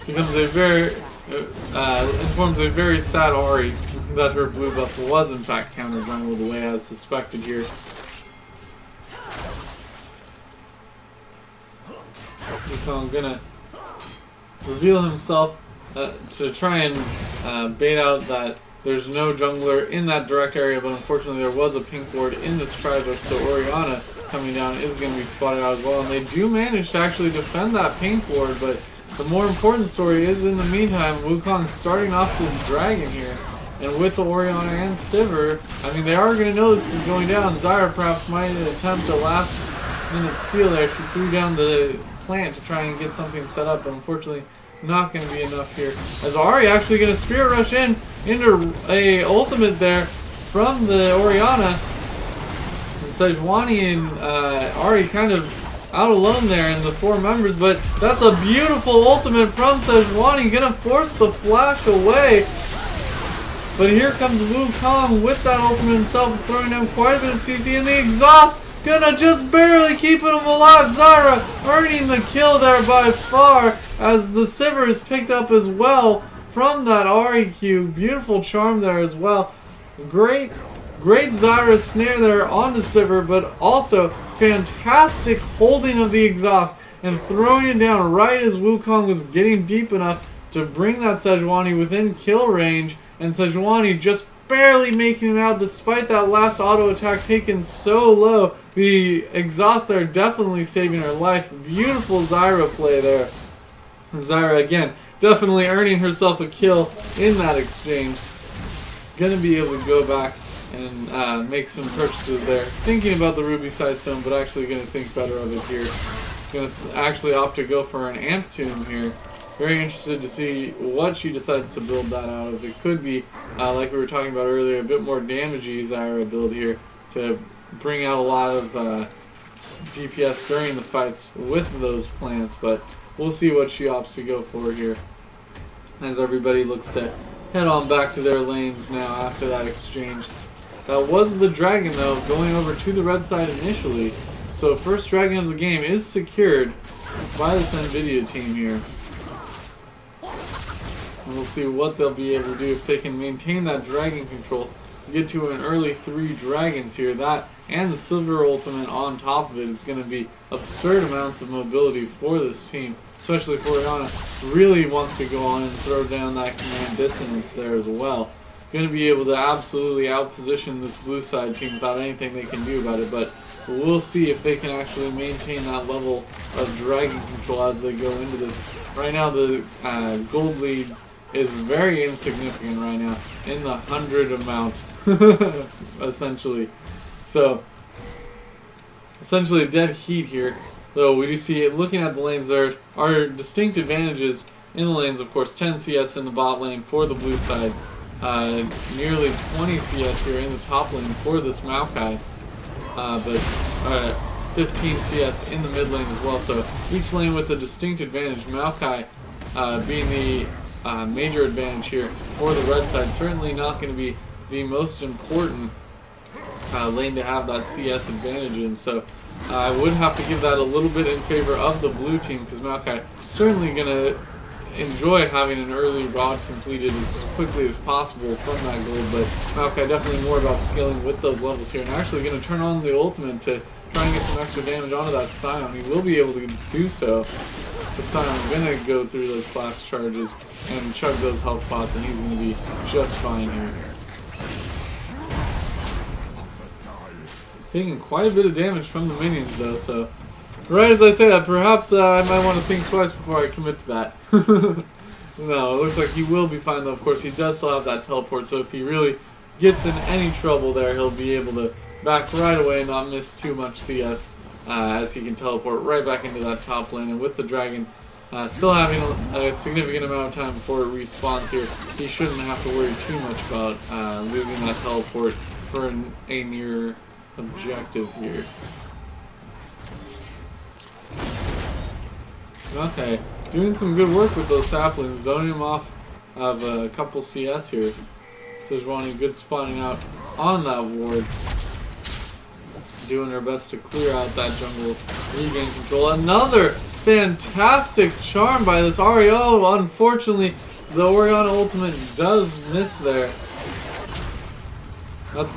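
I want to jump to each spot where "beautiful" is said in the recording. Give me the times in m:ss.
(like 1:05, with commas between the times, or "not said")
0:58, 1:17, 1:41.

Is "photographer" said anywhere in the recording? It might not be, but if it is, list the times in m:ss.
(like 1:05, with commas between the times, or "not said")
not said.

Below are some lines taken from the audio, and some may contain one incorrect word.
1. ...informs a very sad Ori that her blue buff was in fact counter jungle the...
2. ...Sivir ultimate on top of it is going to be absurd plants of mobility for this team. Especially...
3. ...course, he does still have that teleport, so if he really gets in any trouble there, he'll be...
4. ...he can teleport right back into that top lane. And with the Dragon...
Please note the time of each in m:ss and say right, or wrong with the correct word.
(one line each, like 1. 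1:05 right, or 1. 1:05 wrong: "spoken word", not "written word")
1. 0:02 right
2. 2:37 wrong: "amounts", not "plants"
3. 4:17 right
4. 4:25 right.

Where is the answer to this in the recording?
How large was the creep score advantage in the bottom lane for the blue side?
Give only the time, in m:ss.
3:15.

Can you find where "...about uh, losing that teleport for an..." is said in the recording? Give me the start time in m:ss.
4:33.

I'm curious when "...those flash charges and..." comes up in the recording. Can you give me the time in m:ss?
3:59.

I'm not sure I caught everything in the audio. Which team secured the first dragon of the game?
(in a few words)
NVIDIA.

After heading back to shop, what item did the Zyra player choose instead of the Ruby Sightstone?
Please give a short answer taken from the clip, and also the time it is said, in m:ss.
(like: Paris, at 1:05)
Amp Tome, at 1:58.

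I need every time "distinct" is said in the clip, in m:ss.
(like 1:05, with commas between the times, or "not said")
3:13, 3:27.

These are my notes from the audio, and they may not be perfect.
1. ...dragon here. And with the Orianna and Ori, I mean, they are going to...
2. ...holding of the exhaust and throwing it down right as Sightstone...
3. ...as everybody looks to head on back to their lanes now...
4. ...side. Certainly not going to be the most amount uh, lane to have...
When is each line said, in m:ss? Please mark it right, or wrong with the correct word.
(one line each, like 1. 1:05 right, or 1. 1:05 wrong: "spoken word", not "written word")
1. 0:32 wrong: "Sivir", not "Ori"
2. 1:25 wrong: "Wukong", not "Sightstone"
3. 2:16 right
4. 3:32 wrong: "important", not "amount".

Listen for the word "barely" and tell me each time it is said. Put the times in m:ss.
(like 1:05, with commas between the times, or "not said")
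1:09, 1:34.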